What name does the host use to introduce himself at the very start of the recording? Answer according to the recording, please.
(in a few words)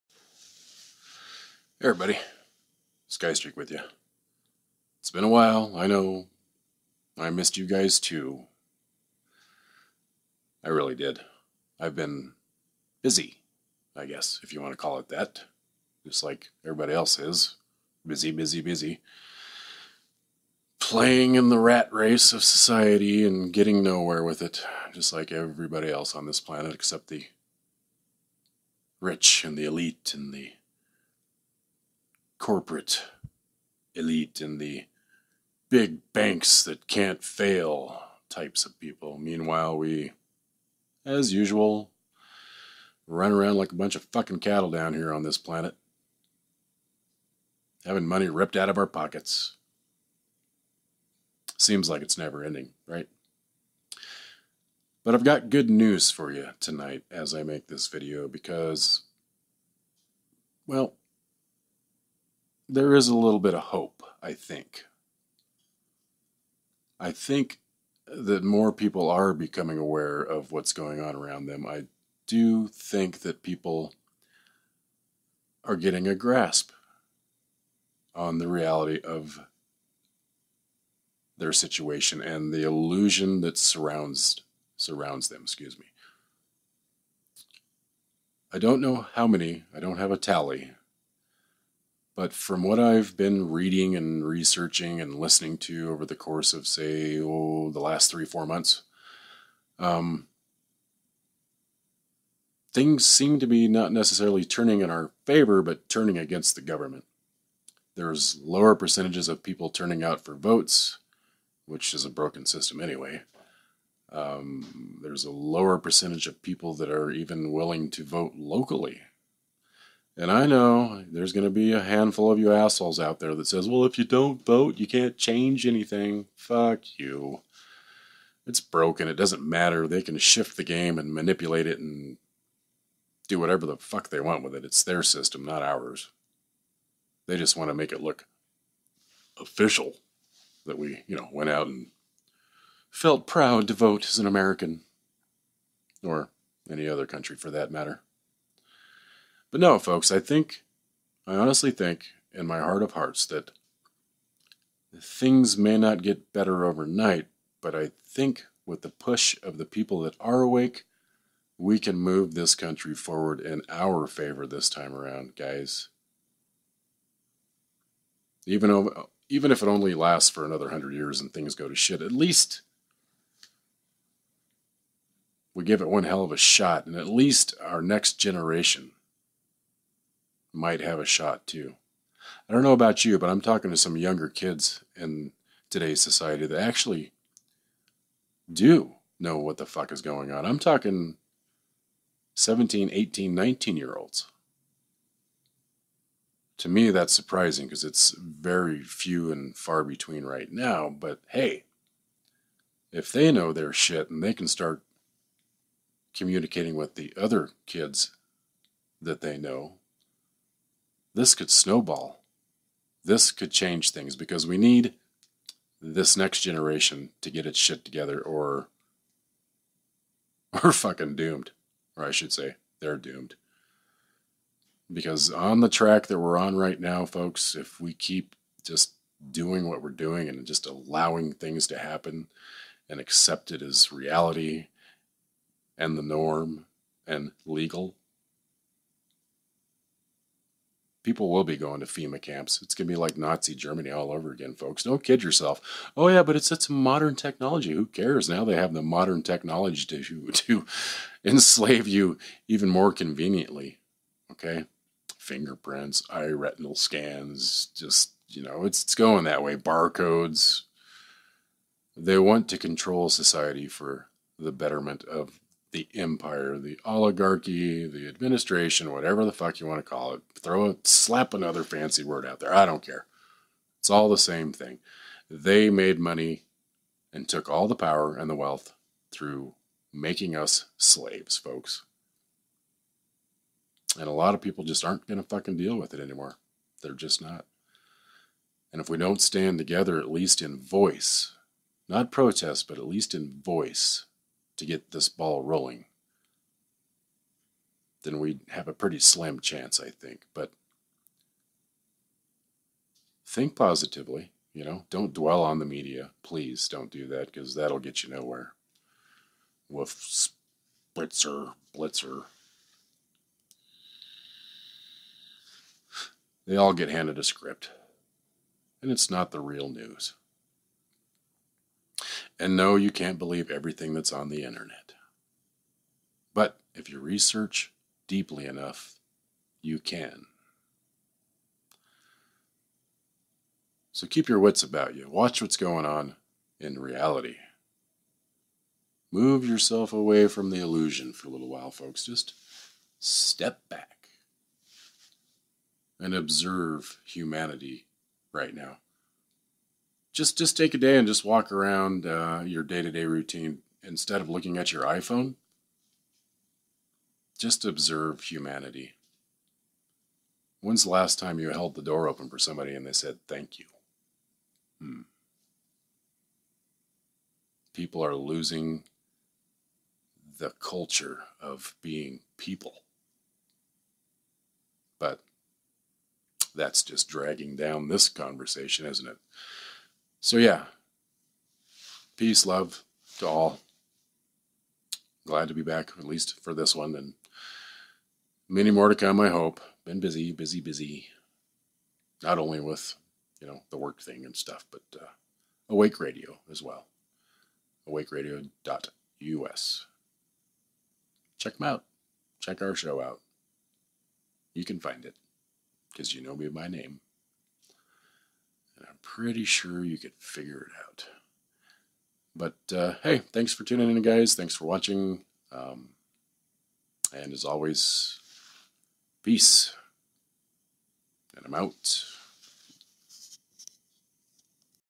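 Skystreak.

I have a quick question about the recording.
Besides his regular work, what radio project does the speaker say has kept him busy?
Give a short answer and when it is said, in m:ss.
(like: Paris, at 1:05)
Awake Radio, at 6:35.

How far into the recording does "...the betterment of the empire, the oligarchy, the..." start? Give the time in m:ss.
4:24.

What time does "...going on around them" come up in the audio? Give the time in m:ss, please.
1:10.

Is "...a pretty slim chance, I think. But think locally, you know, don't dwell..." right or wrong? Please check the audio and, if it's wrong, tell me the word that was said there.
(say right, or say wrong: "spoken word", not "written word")
wrong: "positively", not "locally".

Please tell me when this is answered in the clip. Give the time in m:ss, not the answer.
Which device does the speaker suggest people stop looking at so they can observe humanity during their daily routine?
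5:54.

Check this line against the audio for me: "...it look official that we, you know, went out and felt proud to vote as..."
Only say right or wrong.
right.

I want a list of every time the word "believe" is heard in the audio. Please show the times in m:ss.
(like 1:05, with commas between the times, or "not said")
5:23.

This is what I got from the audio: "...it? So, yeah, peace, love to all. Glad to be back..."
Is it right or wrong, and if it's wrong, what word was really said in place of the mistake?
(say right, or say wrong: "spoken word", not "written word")
right.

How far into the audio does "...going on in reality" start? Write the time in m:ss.
5:35.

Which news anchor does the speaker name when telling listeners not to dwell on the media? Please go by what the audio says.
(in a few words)
Wolf Blitzer.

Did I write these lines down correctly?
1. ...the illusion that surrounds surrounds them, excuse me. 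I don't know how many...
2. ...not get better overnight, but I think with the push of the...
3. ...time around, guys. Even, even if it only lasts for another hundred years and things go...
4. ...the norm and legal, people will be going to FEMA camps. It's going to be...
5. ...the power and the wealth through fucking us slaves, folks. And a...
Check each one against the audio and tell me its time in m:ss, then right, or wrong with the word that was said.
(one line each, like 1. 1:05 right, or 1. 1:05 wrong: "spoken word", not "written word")
1. 1:22 right
2. 2:35 right
3. 2:44 right
4. 3:55 right
5. 4:37 wrong: "making", not "fucking".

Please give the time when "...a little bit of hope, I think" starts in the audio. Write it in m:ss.
1:03.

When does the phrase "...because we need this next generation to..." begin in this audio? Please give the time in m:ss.
3:34.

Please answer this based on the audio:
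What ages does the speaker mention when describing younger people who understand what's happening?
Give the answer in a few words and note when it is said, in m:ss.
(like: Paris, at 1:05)
17, 18, 19, at 3:12.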